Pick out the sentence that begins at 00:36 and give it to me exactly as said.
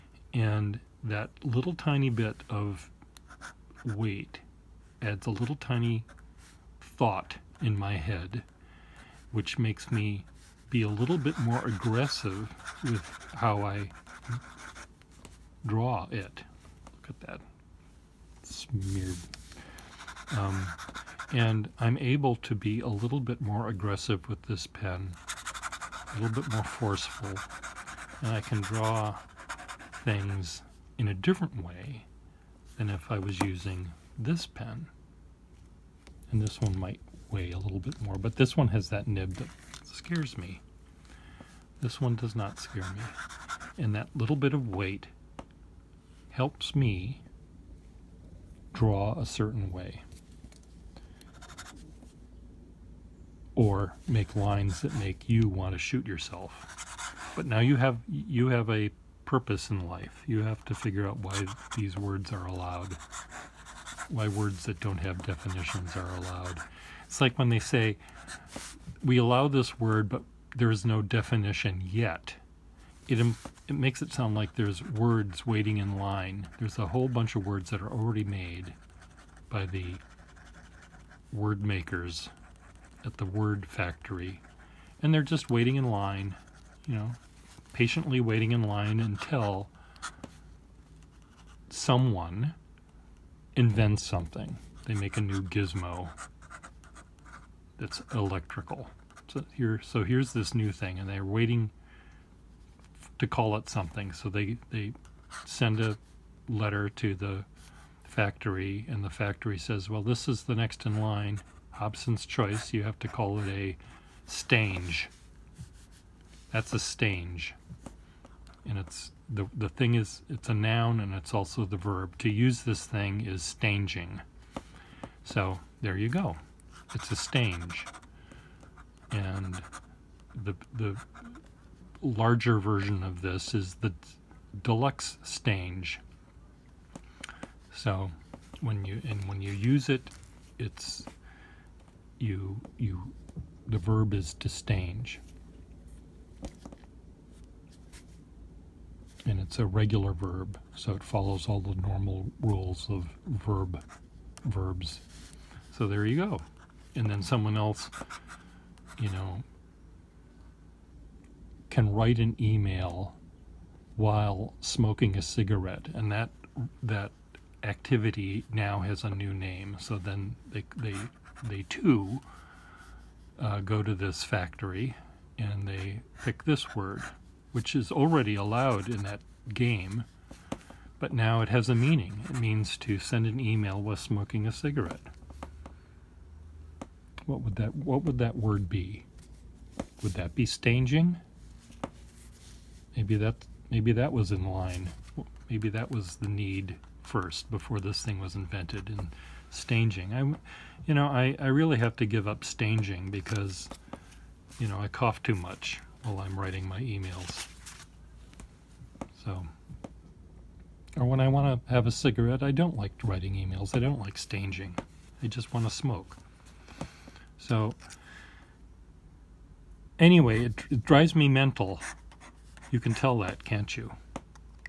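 And this one might way a little bit more.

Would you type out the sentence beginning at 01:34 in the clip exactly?
They make a new gizmo it's electrical.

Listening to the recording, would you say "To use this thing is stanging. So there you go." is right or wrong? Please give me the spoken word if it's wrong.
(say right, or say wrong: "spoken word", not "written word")
right.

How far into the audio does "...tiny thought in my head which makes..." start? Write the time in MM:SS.
00:05.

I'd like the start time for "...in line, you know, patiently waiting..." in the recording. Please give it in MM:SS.
01:25.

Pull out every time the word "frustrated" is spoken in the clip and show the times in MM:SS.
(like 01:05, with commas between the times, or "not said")
not said.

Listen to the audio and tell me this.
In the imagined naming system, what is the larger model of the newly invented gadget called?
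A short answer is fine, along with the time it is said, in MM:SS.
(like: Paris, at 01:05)
deluxe stange, at 02:14.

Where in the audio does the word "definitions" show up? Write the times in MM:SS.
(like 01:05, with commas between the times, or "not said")
01:05, 01:11.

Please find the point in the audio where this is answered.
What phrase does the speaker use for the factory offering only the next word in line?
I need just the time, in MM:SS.
01:51.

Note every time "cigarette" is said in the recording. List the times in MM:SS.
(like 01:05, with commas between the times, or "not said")
02:45, 03:04, 03:31.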